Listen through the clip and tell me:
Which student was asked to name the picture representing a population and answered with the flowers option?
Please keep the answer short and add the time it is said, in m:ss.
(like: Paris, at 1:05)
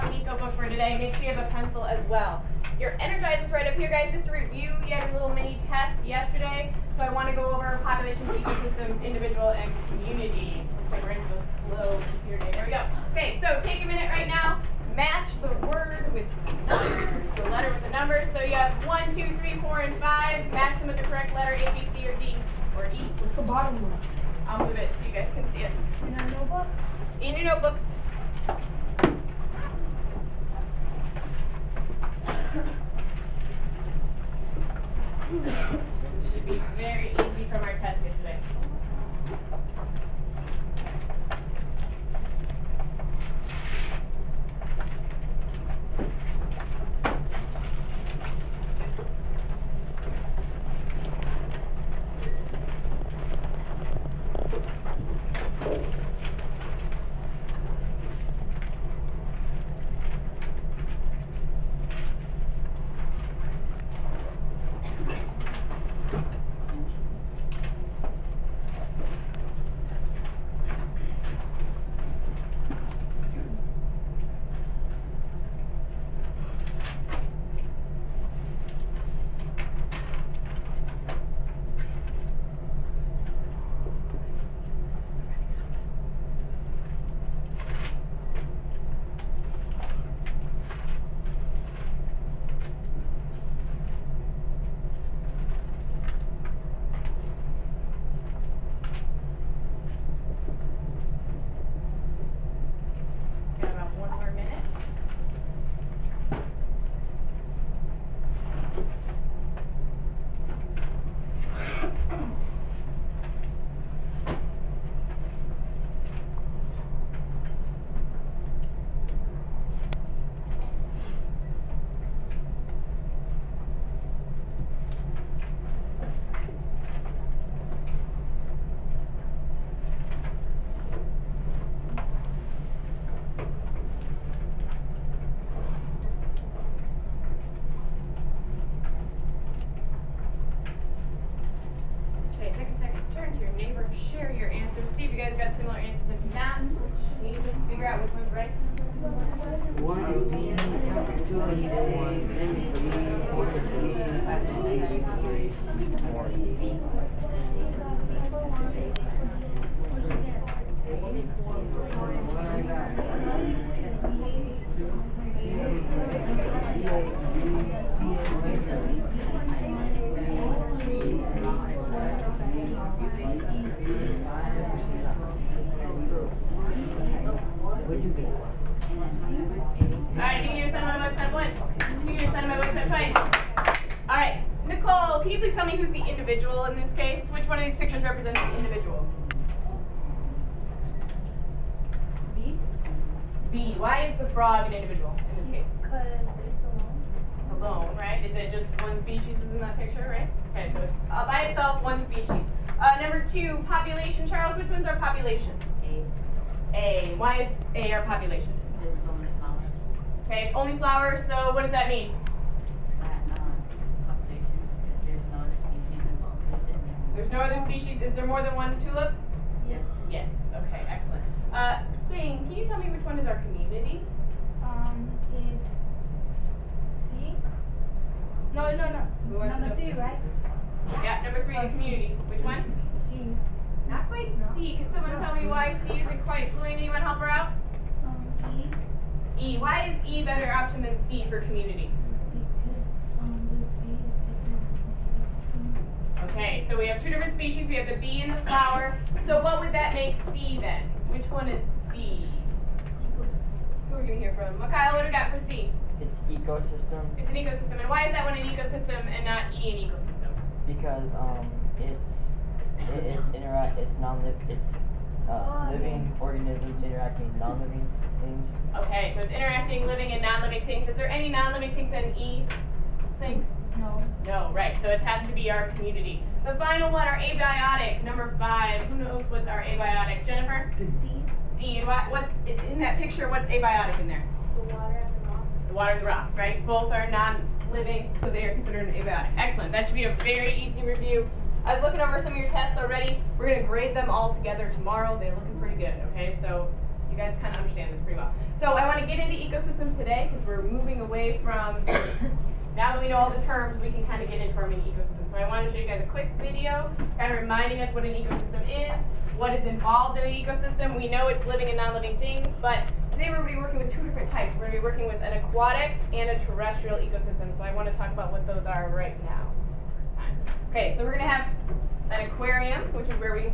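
Charles, at 3:24.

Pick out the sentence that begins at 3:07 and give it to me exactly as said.
Which one of these pictures represents the individual?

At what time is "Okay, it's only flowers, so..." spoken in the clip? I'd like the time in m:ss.
3:30.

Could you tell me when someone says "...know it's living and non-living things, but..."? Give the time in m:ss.
5:11.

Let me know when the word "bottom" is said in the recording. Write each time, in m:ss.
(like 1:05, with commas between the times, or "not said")
0:23.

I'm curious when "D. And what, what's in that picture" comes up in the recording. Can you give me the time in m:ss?
4:41.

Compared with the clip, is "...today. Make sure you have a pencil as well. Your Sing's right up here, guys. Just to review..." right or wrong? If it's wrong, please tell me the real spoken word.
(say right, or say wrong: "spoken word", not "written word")
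wrong: "Energizer", not "Sing".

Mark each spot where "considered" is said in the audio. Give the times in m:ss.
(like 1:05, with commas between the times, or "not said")
4:48.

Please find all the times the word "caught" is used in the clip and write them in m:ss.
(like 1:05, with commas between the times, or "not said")
not said.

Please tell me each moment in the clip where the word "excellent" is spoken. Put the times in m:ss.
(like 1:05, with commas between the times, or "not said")
3:40, 4:49.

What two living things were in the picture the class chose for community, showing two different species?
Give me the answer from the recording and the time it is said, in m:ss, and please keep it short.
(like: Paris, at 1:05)
the bee and the flower, at 4:07.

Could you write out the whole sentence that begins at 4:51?
I was looking over some of your tests already.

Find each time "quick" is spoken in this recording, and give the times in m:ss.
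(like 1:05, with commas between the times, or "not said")
5:06.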